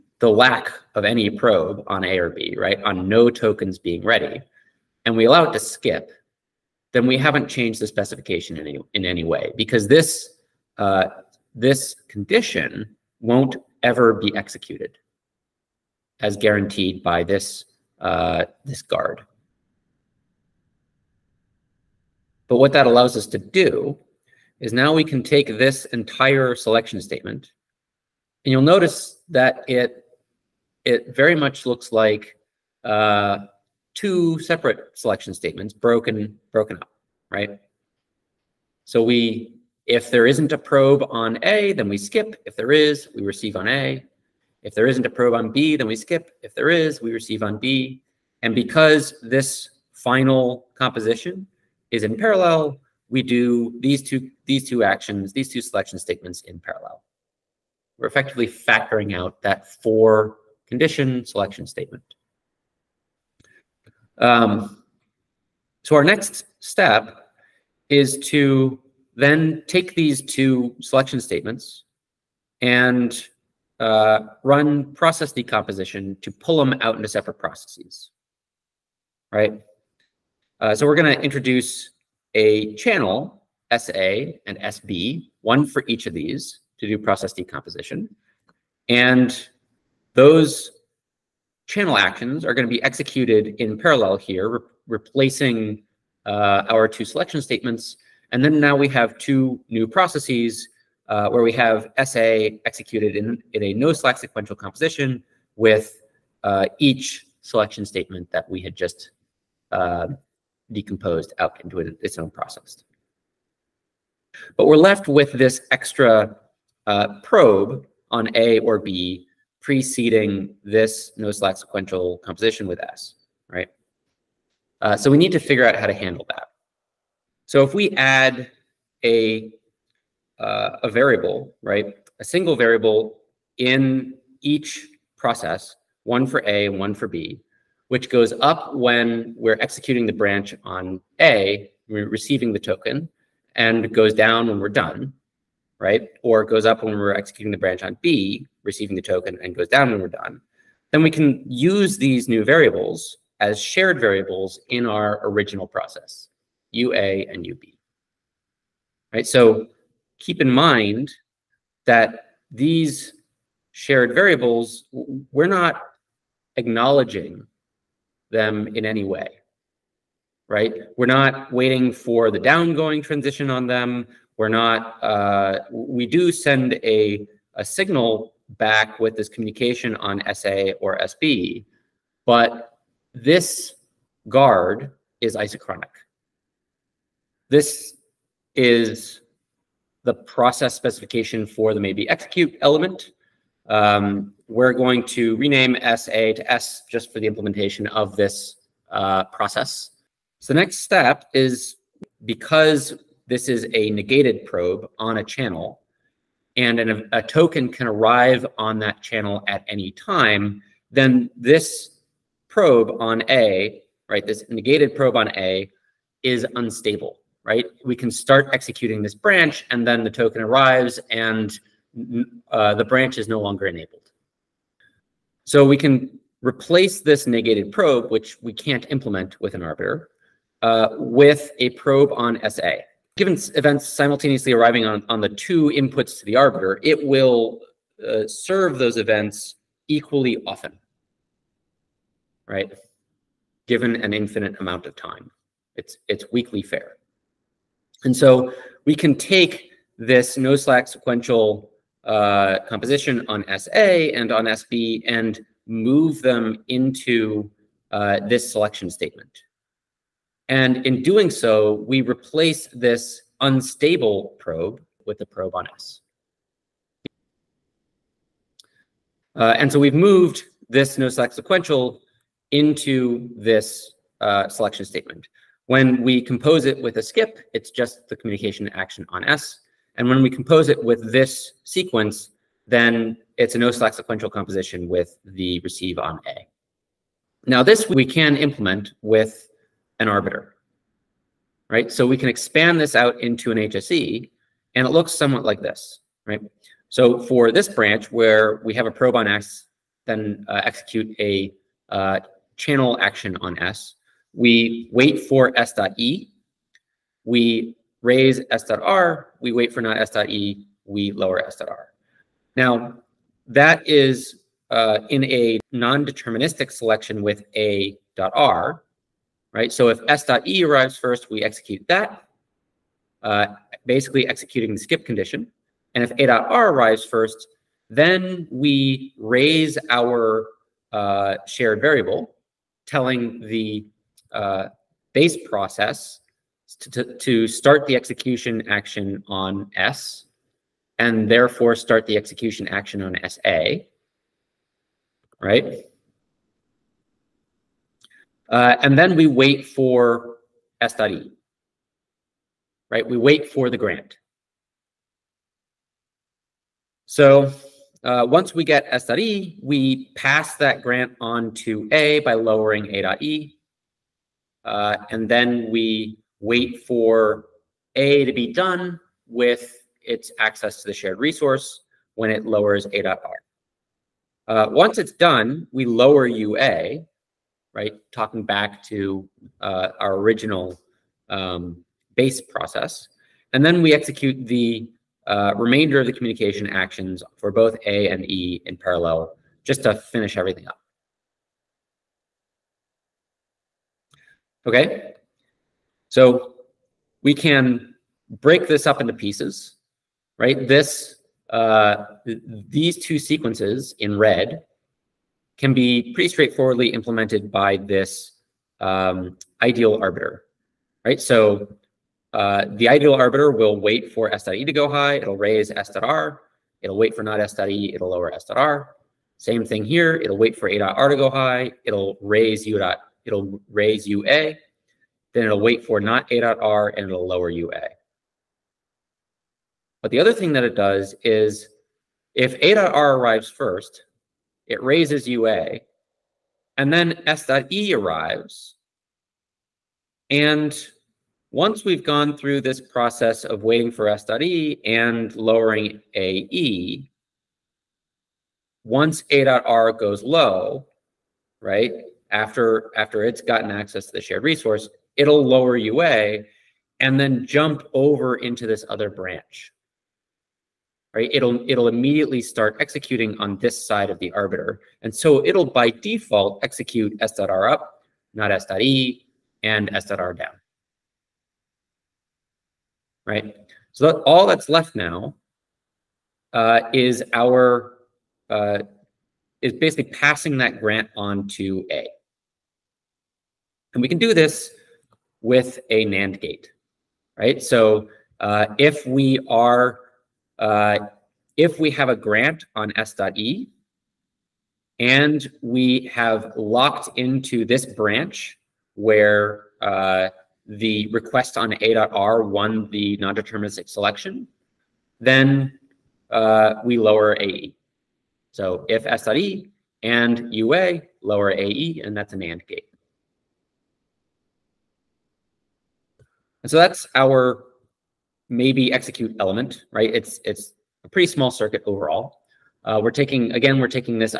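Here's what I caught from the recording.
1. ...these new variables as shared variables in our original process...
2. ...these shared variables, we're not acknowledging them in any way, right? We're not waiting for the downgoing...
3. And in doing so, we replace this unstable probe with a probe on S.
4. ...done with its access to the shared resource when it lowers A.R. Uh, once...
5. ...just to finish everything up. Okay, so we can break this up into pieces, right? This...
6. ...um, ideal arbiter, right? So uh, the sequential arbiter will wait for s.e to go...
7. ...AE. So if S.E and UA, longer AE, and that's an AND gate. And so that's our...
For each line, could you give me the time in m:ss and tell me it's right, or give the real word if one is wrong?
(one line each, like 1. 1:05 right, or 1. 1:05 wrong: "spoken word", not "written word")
1. 2:31 right
2. 2:42 right
3. 4:20 right
4. 6:08 right
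5. 6:29 right
6. 6:48 wrong: "ideal", not "sequential"
7. 8:27 wrong: "lower", not "longer".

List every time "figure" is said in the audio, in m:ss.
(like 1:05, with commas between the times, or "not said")
2:05.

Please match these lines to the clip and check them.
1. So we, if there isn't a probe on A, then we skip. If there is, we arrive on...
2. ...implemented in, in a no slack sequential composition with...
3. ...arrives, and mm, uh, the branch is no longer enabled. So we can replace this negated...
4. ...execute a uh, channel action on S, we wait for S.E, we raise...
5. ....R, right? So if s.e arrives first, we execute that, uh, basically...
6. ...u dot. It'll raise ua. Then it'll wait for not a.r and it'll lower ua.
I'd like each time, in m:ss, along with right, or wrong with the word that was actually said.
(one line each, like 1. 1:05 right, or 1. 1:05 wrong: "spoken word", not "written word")
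1. 0:38 wrong: "receive", not "arrive"
2. 1:42 wrong: "executed", not "implemented"
3. 3:40 right
4. 5:00 right
5. 5:18 right
6. 7:02 right.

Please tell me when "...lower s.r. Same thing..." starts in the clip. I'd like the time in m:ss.
6:58.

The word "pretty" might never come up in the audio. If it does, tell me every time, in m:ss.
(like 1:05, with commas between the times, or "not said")
6:46, 8:41.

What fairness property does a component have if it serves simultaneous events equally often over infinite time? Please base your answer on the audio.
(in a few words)
weakly fair.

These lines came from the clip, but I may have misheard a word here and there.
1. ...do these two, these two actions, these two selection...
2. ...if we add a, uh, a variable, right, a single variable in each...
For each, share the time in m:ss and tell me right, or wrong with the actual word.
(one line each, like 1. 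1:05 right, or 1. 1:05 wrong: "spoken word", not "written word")
1. 0:53 right
2. 2:07 right.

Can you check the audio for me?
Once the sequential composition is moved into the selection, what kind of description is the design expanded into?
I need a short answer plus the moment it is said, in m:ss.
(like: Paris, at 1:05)
HSE, at 4:53.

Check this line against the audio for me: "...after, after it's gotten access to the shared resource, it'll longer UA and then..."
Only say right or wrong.
wrong.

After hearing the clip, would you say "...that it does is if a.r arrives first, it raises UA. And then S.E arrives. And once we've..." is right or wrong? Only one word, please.
right.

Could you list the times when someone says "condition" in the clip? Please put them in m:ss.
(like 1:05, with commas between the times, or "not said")
0:12, 1:00, 5:25.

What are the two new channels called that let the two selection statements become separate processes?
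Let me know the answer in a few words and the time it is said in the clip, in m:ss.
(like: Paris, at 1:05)
SA and SB, at 1:23.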